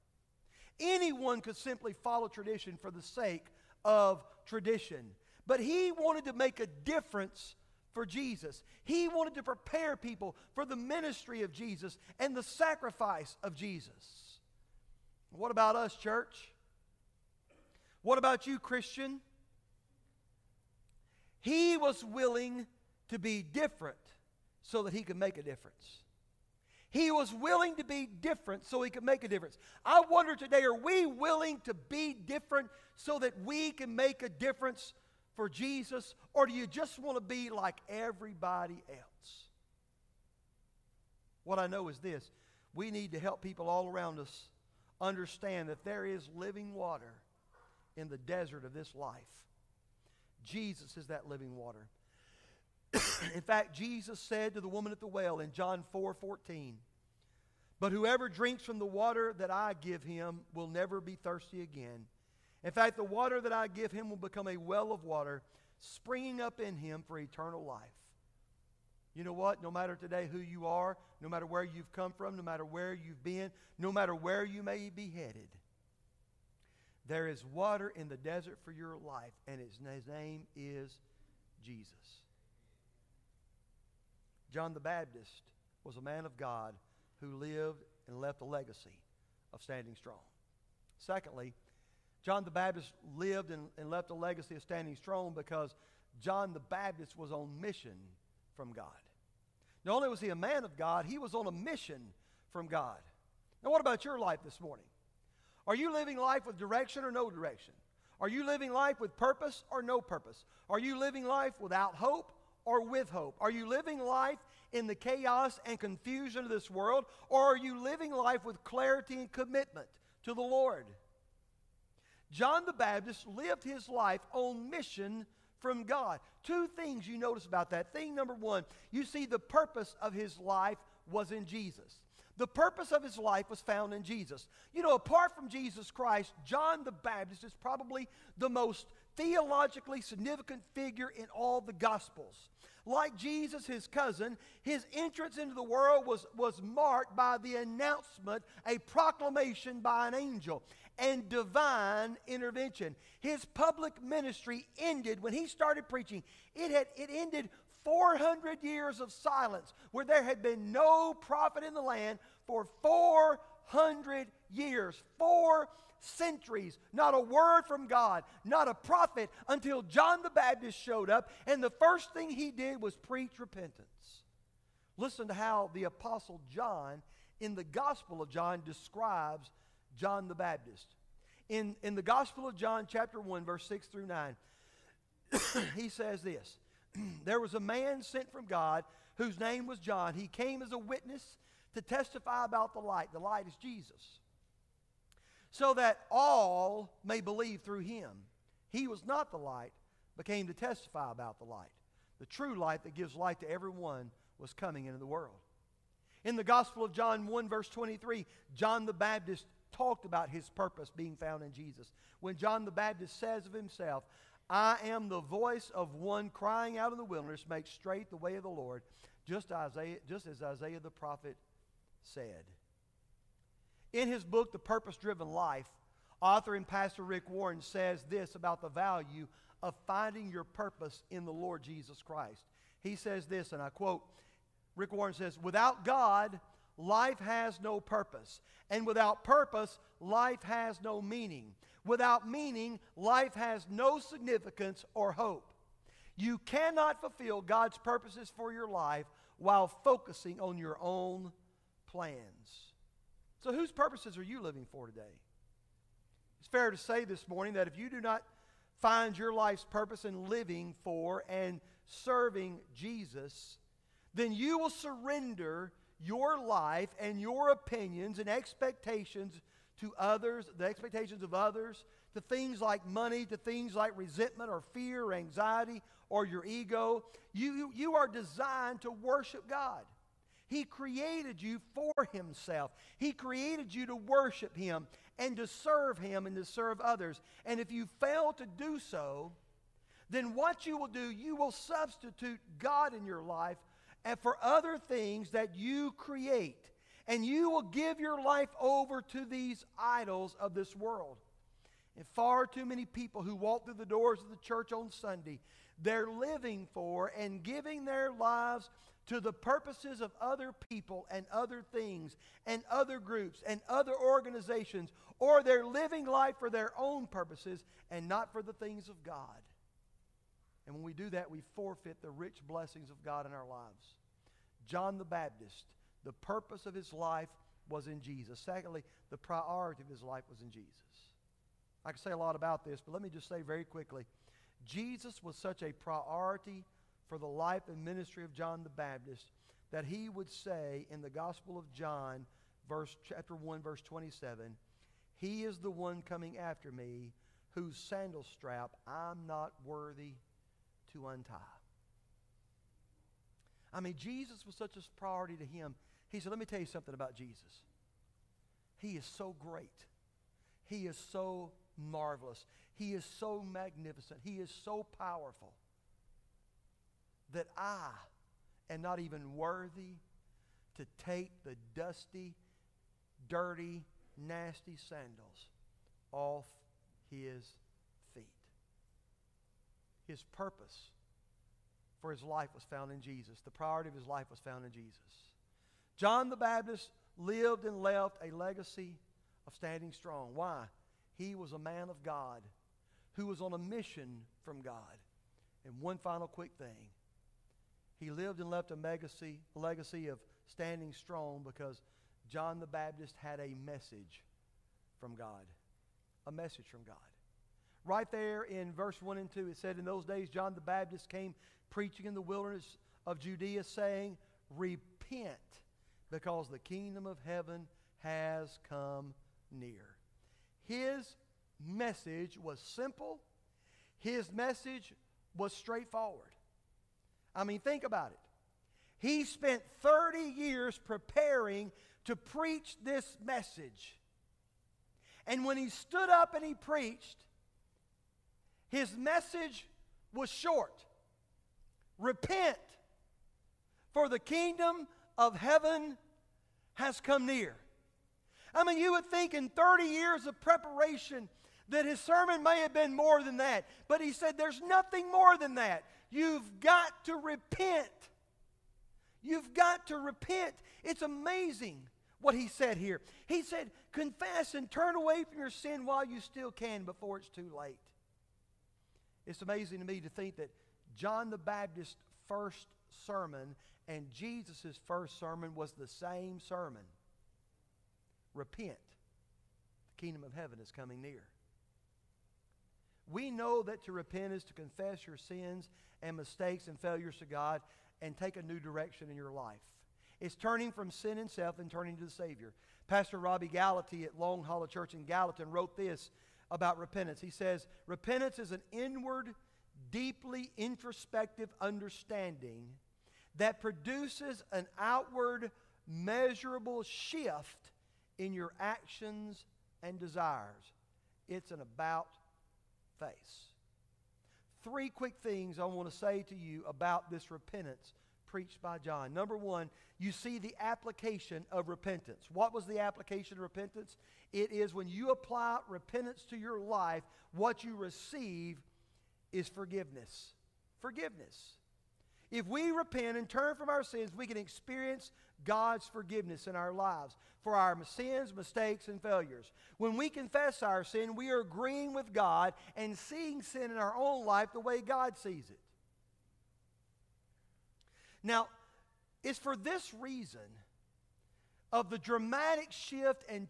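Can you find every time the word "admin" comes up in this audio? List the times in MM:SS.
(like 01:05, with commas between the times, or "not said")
not said.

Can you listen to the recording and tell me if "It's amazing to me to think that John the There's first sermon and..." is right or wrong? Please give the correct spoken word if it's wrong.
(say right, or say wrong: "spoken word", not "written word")
wrong: "Baptist", not "There".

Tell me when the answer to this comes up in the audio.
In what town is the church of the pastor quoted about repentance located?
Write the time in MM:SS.
08:15.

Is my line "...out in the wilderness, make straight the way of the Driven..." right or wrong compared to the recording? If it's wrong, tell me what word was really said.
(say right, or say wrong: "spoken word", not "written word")
wrong: "Lord", not "Driven".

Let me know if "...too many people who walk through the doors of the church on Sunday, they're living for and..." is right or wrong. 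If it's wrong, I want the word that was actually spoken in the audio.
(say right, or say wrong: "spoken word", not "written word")
right.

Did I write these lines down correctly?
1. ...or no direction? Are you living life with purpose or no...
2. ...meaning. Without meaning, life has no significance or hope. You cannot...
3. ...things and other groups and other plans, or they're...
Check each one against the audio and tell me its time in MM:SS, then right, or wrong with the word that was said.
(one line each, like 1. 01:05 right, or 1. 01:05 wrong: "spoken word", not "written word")
1. 01:47 right
2. 04:00 right
3. 05:11 wrong: "organizations", not "plans".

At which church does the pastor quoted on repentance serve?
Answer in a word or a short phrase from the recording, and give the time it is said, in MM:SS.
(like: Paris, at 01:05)
Long Hollow Church, at 08:14.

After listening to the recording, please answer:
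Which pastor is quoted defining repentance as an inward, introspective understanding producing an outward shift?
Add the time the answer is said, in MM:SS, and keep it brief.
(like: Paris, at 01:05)
Robby Gallaty, at 08:13.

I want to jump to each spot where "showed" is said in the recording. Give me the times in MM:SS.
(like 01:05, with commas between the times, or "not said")
02:50.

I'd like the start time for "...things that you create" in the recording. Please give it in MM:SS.
04:54.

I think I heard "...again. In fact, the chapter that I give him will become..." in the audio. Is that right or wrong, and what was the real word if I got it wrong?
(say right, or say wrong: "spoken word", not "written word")
wrong: "water", not "chapter".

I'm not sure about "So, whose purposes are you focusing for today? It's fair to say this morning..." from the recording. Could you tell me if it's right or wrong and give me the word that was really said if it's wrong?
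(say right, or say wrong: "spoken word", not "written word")
wrong: "living", not "focusing".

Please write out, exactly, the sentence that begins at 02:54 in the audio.
Listen to how the Apostle John in the Gospel of John describes John the Baptist.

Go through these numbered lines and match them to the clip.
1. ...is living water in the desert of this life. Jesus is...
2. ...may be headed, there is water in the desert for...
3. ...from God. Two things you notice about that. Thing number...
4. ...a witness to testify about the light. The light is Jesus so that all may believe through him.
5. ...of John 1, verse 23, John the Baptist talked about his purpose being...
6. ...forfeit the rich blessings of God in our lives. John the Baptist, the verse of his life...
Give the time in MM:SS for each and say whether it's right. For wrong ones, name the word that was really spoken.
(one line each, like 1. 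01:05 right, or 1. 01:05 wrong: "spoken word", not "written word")
1. 00:46 right
2. 01:14 right
3. 02:05 right
4. 03:10 right
5. 03:26 right
6. 05:21 wrong: "purpose", not "verse".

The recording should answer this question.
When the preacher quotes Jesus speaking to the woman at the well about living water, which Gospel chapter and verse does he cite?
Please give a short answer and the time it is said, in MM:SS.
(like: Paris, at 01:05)
John 4:14, at 00:55.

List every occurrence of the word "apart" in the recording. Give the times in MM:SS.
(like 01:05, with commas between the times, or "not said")
02:14.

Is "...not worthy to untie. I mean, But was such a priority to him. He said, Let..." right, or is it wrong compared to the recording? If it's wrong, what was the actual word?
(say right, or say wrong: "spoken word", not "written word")
wrong: "Jesus", not "But".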